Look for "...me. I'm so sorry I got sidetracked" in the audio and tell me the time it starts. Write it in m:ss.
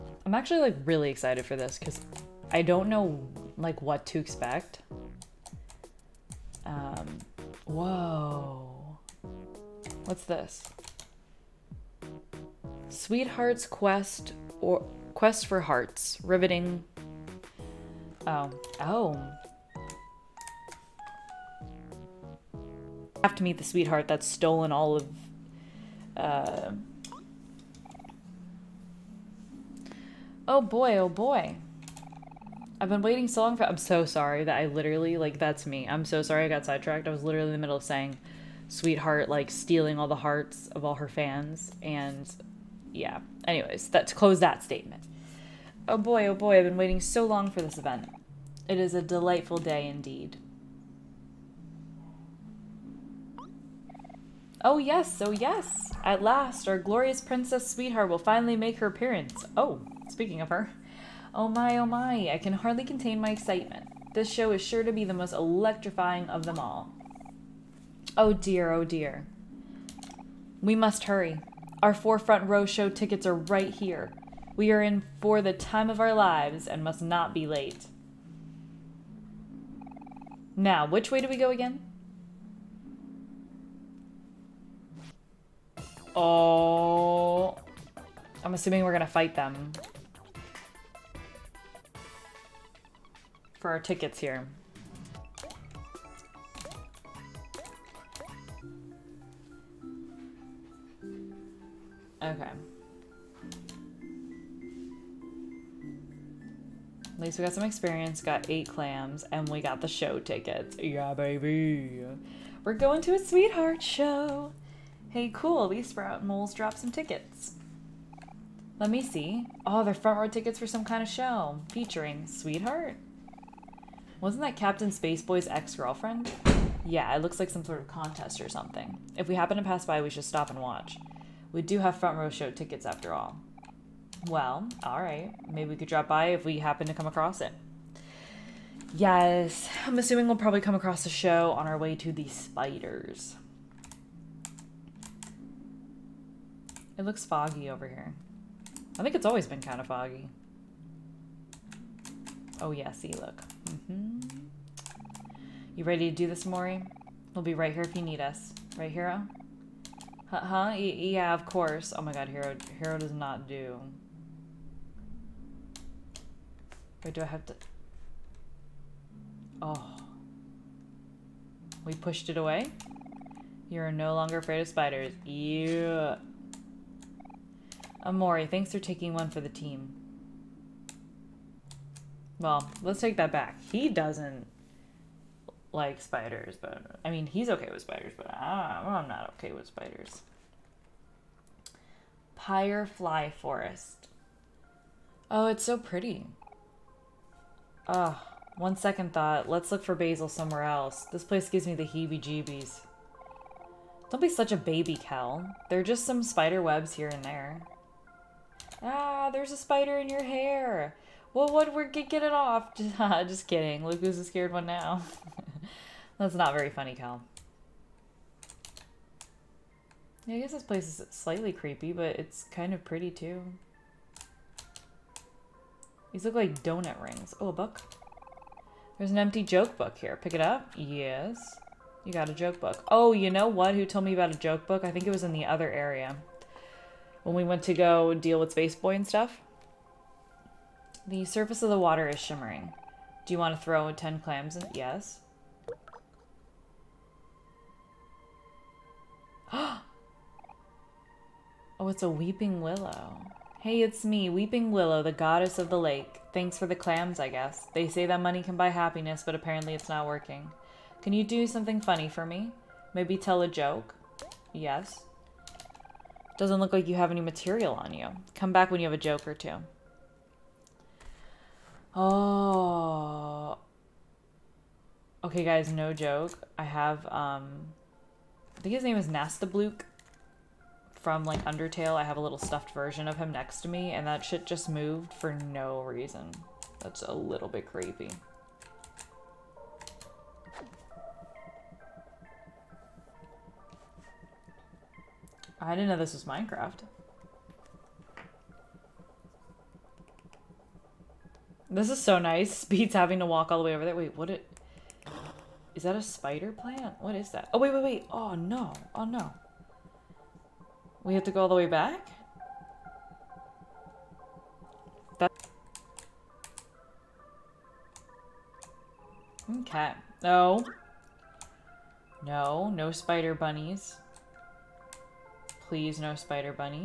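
0:35.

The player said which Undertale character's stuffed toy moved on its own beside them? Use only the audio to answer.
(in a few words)
Napstablook.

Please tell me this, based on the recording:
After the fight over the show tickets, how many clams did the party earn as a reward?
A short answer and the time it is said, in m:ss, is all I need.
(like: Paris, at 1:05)
8, at 1:48.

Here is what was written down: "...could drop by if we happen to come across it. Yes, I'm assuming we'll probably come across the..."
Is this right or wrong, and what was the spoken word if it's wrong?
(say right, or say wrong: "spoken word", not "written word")
right.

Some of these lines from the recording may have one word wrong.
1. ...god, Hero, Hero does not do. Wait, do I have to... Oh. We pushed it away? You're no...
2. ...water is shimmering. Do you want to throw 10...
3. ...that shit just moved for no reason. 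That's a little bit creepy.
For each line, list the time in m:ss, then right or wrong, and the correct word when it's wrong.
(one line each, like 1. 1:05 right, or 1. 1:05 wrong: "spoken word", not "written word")
1. 2:42 right
2. 4:01 right
3. 4:44 right.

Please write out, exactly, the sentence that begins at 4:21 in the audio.
Can you do something funny for me?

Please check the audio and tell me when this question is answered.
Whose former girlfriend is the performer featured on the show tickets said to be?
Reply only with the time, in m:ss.
2:04.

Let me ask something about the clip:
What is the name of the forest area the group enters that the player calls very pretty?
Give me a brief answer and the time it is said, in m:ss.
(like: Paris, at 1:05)
Pyrefly Forest, at 3:12.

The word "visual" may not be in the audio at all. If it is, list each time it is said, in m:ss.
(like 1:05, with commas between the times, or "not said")
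not said.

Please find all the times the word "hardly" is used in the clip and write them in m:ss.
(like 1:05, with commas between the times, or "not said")
1:02.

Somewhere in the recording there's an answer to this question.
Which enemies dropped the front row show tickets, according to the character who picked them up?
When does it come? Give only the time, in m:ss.
1:55.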